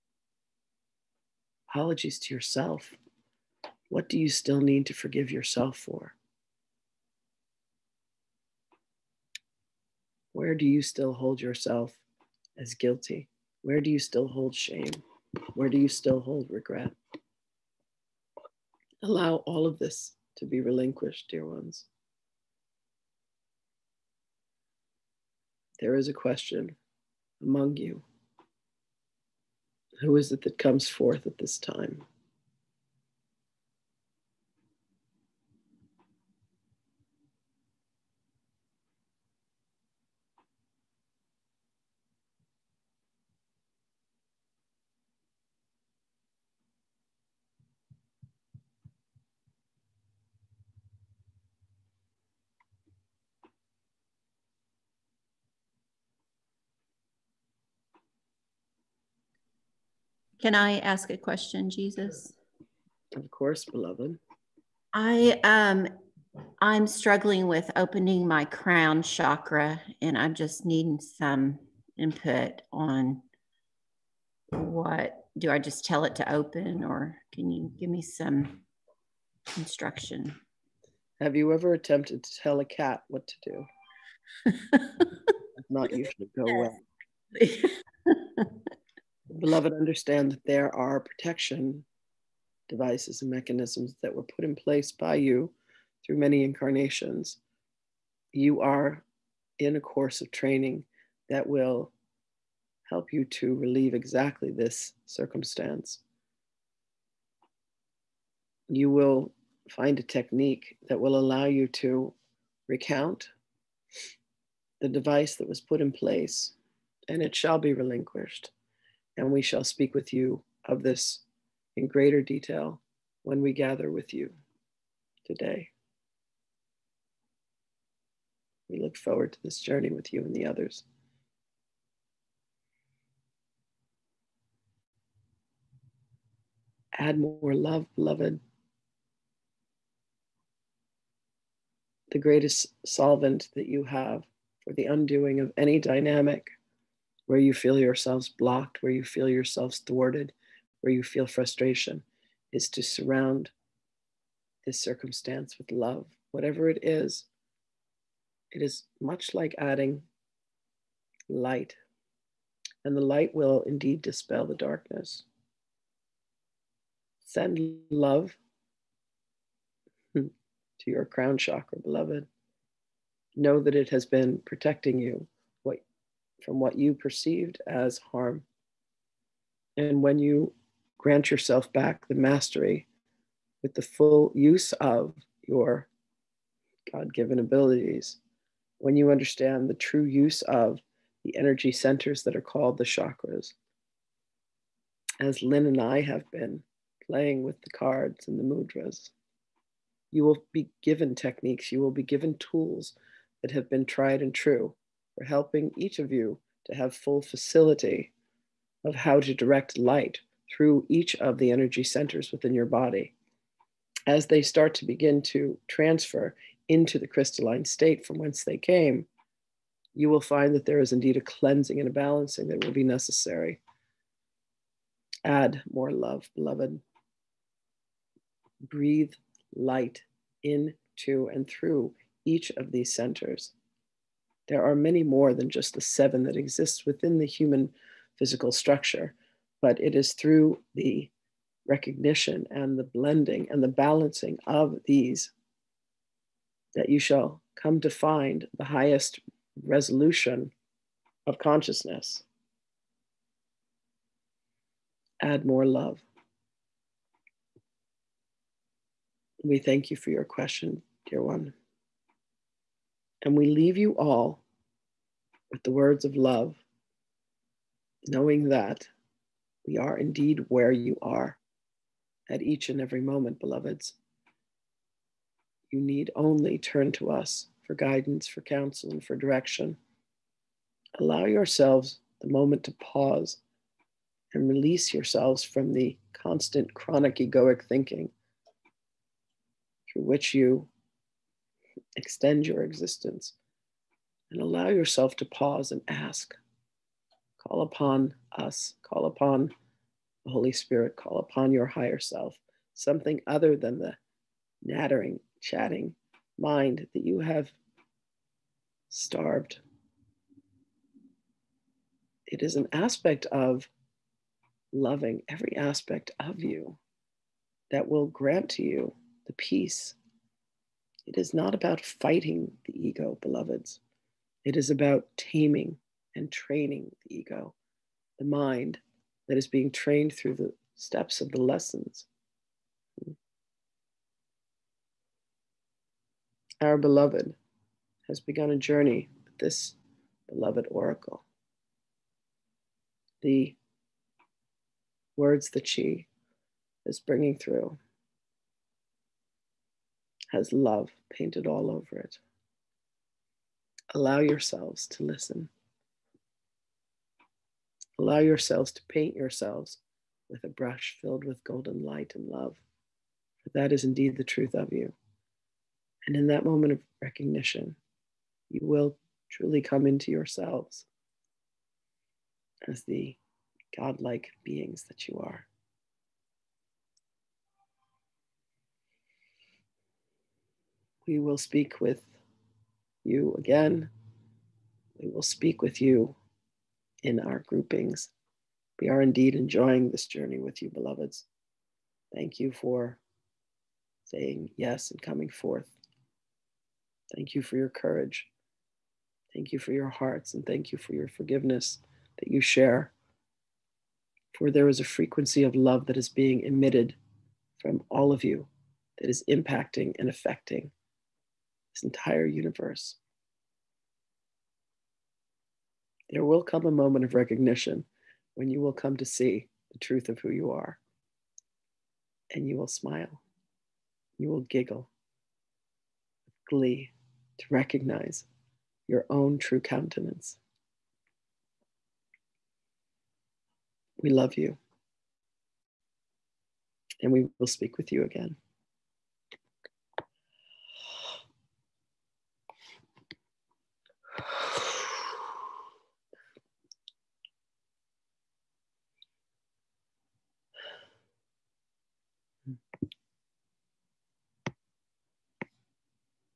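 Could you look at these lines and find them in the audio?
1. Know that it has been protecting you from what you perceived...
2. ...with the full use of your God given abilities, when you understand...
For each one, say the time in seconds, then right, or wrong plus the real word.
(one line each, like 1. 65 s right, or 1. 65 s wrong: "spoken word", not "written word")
1. 173 s right
2. 183 s right.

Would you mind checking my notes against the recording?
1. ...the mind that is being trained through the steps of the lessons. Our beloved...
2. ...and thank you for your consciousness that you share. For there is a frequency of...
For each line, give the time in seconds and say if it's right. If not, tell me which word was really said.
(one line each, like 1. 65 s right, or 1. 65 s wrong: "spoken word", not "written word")
1. 328 s right
2. 400 s wrong: "forgiveness", not "consciousness".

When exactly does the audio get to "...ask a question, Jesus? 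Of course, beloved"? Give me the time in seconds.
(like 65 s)
60 s.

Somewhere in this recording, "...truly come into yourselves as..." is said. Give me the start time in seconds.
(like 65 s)
369 s.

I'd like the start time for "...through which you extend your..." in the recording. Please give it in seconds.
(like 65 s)
289 s.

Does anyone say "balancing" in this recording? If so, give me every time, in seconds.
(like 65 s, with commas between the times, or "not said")
221 s, 243 s.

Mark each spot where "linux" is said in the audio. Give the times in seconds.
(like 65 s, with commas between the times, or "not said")
not said.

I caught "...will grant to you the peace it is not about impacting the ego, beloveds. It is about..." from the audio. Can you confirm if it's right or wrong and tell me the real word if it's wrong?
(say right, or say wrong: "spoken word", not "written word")
wrong: "fighting", not "impacting".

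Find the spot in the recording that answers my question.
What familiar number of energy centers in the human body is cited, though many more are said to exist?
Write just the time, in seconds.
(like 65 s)
235 s.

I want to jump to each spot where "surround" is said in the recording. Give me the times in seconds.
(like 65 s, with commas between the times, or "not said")
152 s.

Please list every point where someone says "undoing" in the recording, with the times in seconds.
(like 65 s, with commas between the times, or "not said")
144 s.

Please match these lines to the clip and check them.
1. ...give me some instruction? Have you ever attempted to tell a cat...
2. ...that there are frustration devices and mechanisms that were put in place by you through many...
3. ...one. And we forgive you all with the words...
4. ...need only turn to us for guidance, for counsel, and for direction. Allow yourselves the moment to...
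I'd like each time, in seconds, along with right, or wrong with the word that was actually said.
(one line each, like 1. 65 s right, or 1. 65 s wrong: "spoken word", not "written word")
1. 77 s right
2. 90 s wrong: "protection", not "frustration"
3. 261 s wrong: "leave", not "forgive"
4. 275 s right.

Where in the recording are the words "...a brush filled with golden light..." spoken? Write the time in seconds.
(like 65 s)
360 s.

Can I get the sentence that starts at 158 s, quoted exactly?
It is much like adding light, and the light will indeed dispel the darkness.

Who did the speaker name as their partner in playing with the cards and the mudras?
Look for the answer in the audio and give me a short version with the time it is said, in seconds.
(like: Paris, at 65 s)
Lynn, at 195 s.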